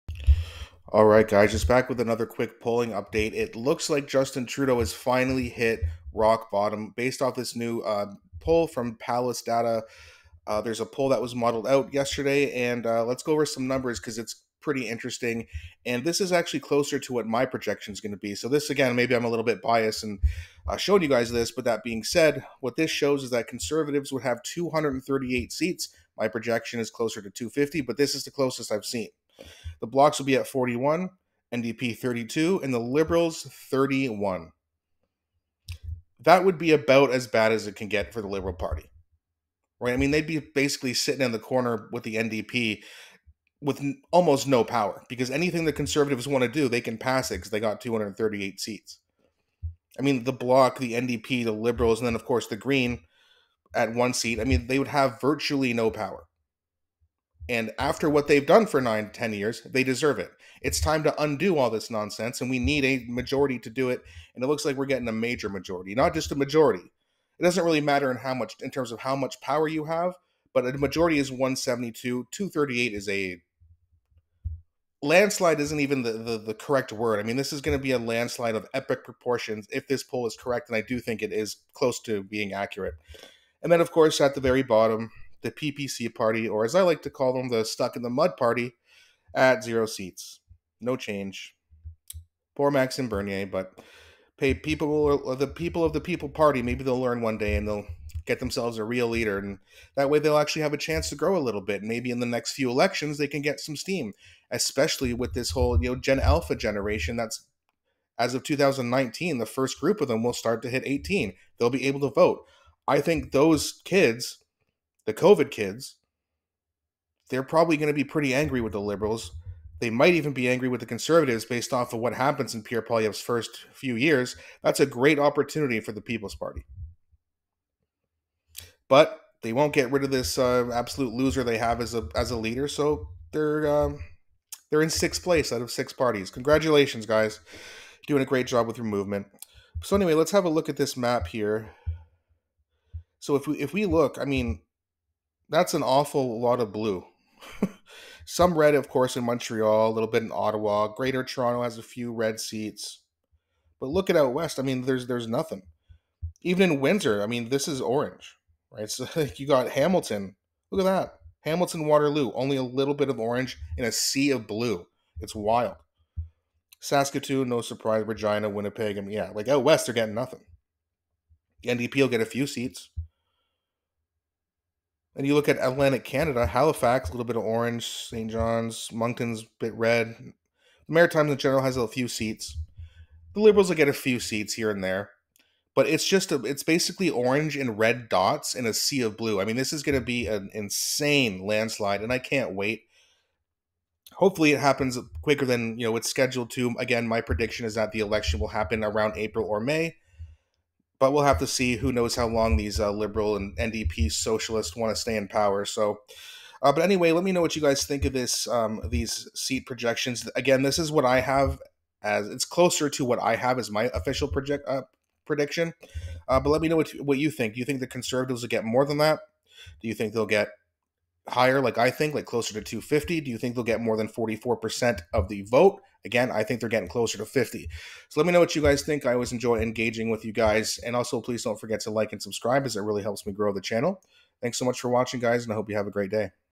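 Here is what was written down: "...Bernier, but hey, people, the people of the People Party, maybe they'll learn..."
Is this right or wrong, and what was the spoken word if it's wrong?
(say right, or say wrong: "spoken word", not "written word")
right.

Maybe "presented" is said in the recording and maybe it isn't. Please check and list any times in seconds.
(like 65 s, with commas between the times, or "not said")
not said.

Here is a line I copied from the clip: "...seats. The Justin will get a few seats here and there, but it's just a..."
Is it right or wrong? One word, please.
wrong.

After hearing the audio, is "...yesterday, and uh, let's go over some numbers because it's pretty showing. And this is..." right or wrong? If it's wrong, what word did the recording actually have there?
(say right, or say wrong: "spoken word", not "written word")
wrong: "interesting", not "showing".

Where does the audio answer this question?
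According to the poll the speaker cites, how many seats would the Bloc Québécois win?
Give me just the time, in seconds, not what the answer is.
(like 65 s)
30 s.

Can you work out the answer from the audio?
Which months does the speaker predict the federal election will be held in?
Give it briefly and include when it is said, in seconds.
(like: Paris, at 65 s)
April or May, at 199 s.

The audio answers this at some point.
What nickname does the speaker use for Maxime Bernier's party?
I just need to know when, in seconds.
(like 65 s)
87 s.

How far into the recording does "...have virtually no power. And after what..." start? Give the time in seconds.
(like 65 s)
54 s.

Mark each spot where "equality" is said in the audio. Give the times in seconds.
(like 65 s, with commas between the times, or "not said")
not said.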